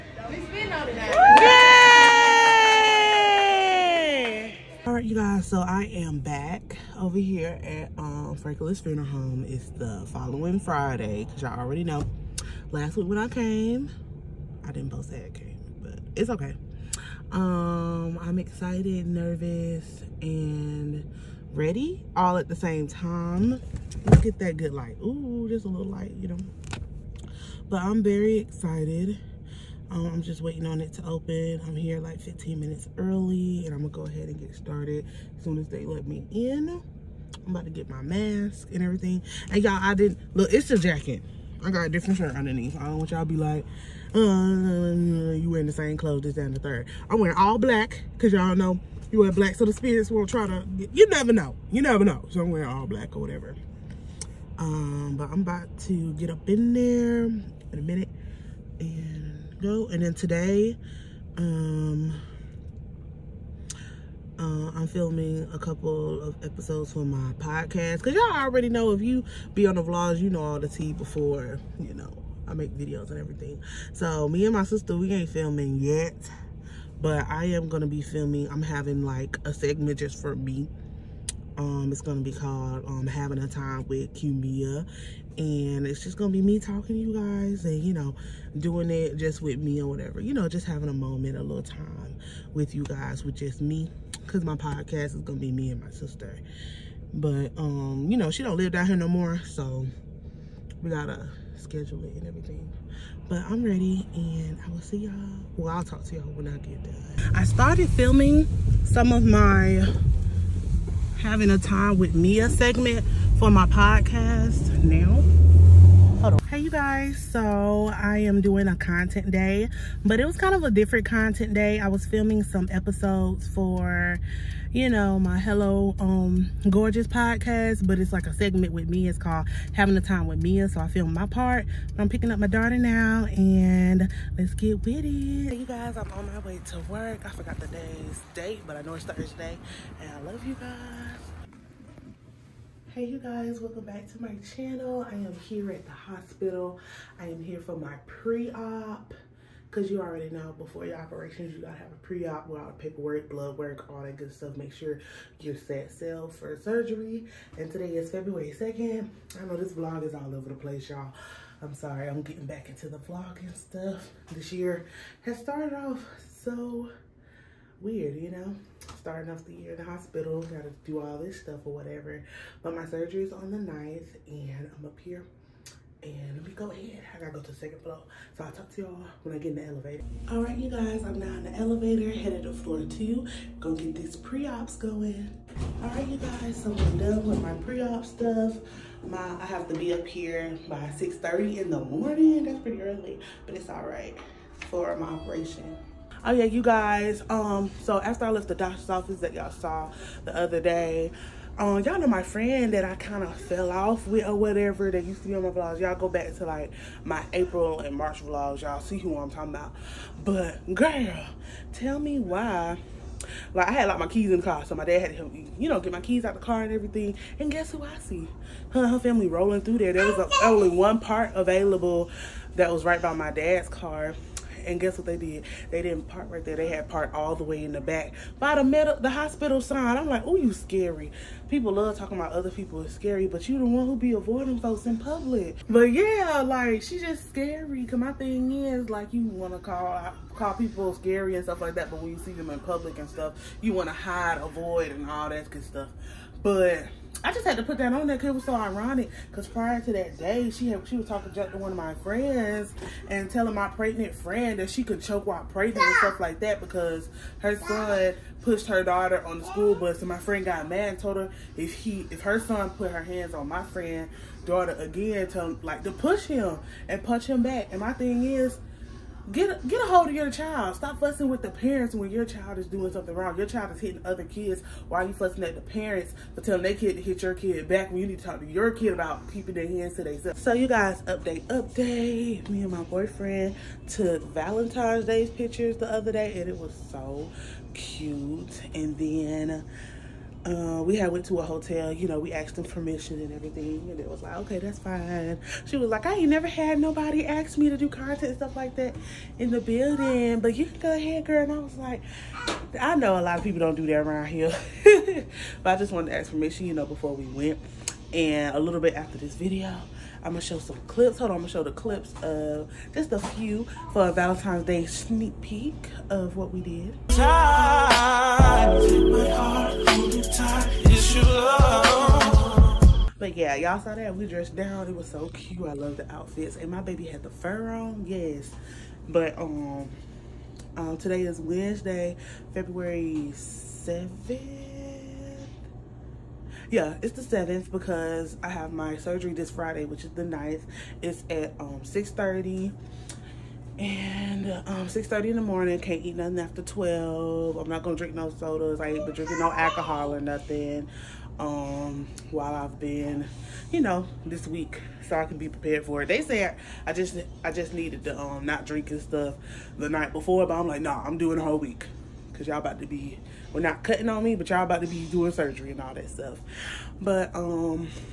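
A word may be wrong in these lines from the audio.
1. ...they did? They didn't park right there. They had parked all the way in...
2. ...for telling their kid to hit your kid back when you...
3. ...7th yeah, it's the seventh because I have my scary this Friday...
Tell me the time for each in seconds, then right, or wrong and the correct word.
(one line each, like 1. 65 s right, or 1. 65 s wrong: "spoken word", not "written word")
1. 225 s right
2. 276 s right
3. 333 s wrong: "surgery", not "scary".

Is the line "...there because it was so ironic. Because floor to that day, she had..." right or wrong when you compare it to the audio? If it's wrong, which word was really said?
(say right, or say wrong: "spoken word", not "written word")
wrong: "prior", not "floor".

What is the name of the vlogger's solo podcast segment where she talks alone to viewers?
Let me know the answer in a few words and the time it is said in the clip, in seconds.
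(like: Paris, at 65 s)
Having a Time with Cumia, at 83 s.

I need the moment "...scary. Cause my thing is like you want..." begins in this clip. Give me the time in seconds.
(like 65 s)
237 s.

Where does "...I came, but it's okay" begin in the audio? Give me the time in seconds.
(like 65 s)
15 s.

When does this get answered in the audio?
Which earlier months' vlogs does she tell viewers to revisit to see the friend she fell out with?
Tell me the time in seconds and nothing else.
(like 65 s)
207 s.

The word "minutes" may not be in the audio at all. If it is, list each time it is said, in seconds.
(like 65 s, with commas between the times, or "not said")
32 s, 57 s.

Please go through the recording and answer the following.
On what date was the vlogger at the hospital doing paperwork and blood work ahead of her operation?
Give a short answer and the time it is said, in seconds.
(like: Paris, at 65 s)
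February 2nd, at 158 s.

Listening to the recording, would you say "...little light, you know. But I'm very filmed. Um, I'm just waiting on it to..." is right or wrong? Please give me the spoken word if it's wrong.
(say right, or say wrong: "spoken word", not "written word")
wrong: "excited", not "filmed".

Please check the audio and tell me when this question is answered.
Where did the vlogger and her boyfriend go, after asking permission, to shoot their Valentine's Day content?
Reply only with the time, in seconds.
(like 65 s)
291 s.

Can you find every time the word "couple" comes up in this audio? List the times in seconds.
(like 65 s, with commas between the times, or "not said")
65 s.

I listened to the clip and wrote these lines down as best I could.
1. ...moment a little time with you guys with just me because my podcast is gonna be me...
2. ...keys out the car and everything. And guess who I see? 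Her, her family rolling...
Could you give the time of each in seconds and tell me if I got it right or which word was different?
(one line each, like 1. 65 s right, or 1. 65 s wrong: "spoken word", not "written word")
1. 90 s right
2. 216 s right.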